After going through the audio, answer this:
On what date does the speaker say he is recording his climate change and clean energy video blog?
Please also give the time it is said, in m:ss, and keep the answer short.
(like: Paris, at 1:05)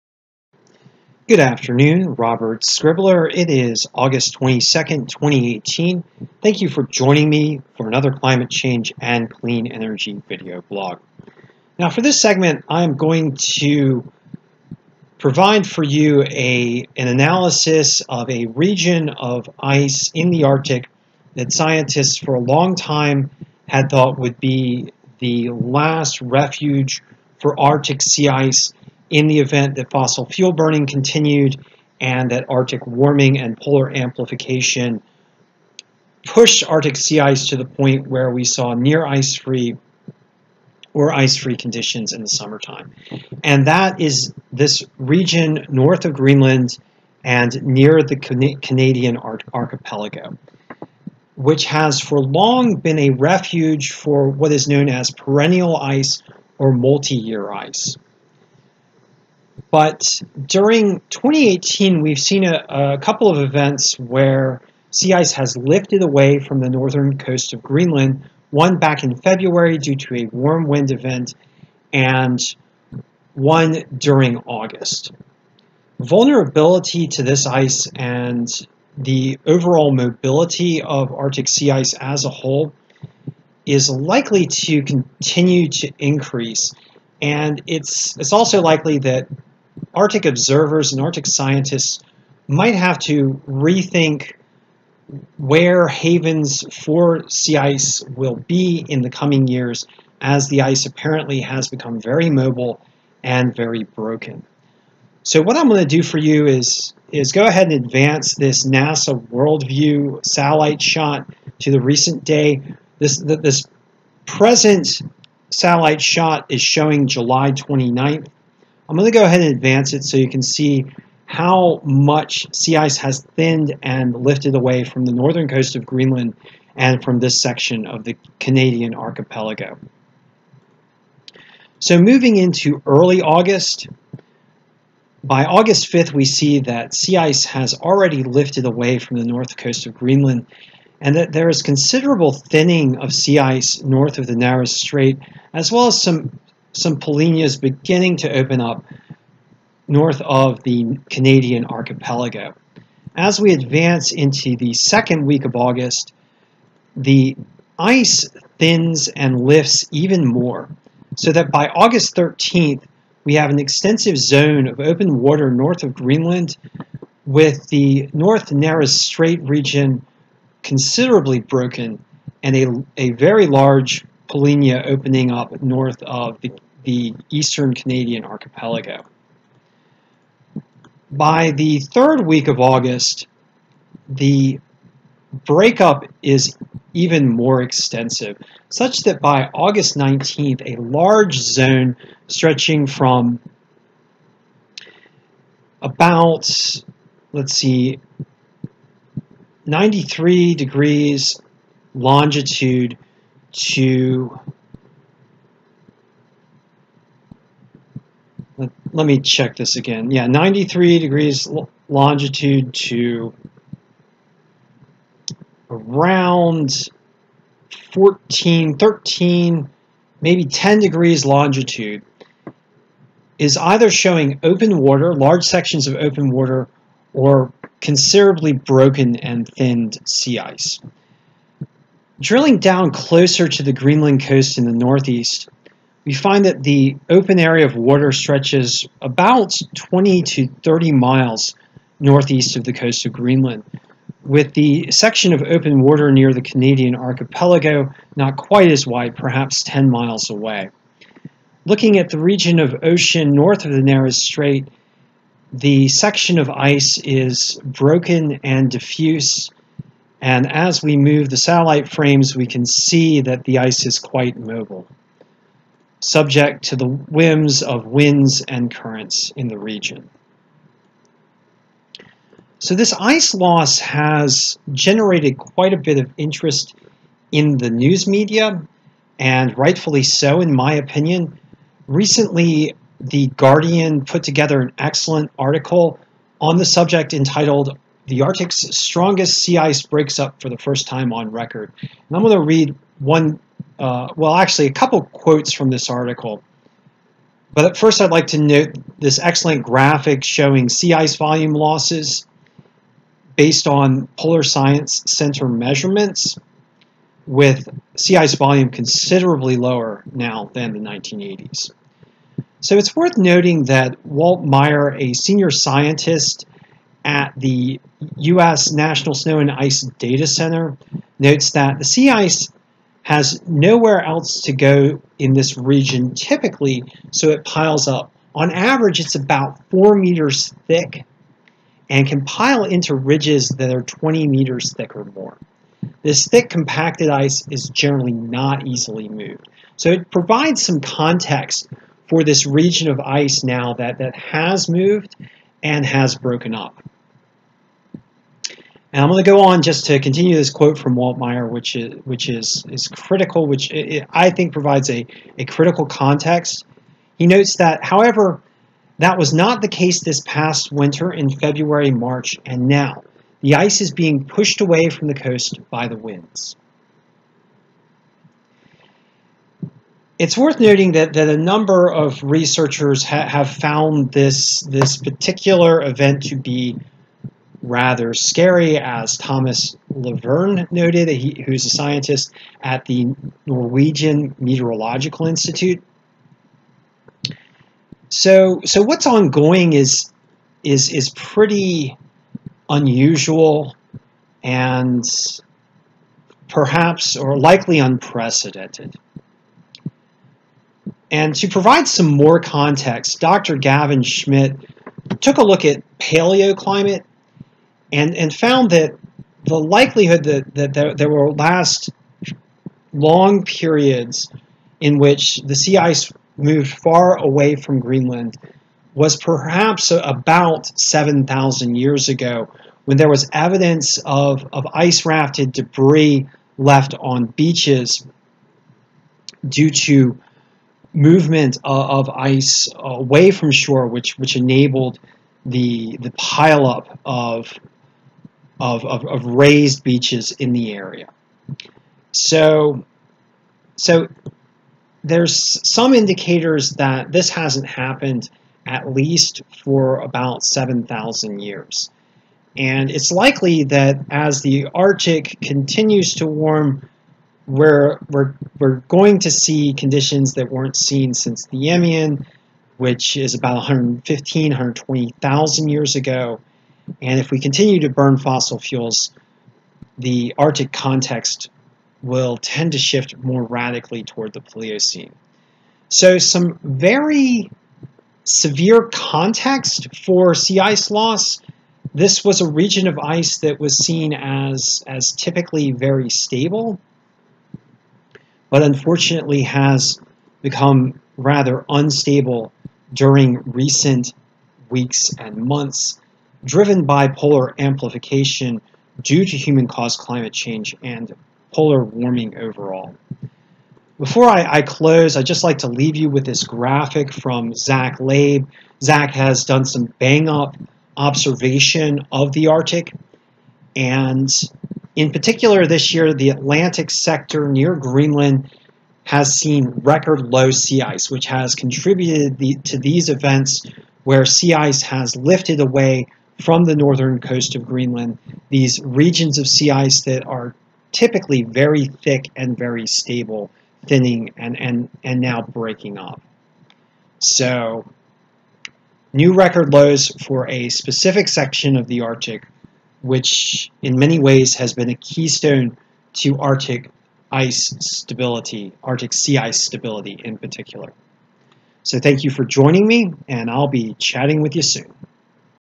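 August 22nd, 2018, at 0:03.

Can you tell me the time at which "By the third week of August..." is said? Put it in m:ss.
3:01.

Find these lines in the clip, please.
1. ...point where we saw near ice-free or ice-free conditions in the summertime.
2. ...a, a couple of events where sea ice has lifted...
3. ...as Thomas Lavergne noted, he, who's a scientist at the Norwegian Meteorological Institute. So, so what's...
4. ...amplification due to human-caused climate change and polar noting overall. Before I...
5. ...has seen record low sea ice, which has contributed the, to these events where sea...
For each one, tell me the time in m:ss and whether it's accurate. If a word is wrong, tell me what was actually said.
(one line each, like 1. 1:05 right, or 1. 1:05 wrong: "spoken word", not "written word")
1. 0:37 right
2. 1:02 right
3. 6:18 right
4. 8:17 wrong: "warming", not "noting"
5. 8:39 right.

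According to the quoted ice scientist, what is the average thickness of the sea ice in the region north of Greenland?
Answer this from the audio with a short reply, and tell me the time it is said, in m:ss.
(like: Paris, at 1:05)
4 meters, at 5:29.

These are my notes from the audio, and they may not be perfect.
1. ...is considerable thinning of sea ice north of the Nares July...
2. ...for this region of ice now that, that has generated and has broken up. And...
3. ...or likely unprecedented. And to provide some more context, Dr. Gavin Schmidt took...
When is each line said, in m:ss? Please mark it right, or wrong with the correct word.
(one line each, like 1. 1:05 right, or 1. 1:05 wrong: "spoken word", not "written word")
1. 2:21 wrong: "Strait", not "July"
2. 5:42 wrong: "moved", not "generated"
3. 6:37 right.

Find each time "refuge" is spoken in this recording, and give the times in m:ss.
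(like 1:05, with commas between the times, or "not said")
0:26, 0:53.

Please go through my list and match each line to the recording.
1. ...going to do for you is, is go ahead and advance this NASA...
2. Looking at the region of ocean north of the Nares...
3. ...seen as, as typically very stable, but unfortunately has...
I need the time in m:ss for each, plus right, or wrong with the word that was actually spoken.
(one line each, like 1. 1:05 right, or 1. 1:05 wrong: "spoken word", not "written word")
1. 1:45 right
2. 4:11 right
3. 8:03 right.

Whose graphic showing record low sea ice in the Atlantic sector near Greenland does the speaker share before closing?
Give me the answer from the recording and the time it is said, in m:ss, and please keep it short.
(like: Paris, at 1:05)
Zach Labe, at 8:27.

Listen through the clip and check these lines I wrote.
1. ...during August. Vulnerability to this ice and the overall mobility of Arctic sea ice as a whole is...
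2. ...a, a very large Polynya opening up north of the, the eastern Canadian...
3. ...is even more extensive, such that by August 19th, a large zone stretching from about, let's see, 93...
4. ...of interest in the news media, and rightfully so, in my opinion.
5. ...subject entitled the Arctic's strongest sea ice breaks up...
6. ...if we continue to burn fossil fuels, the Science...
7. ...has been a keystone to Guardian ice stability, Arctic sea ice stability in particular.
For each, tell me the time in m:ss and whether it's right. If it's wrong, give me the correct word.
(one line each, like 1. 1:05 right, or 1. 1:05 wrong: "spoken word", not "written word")
1. 1:13 right
2. 2:52 right
3. 3:06 right
4. 4:35 right
5. 4:46 right
6. 7:47 wrong: "Arctic", not "Science"
7. 9:04 wrong: "Arctic", not "Guardian".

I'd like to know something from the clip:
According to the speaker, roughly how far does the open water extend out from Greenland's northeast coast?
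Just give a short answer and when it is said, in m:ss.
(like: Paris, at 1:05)
20 to 30 miles, at 3:59.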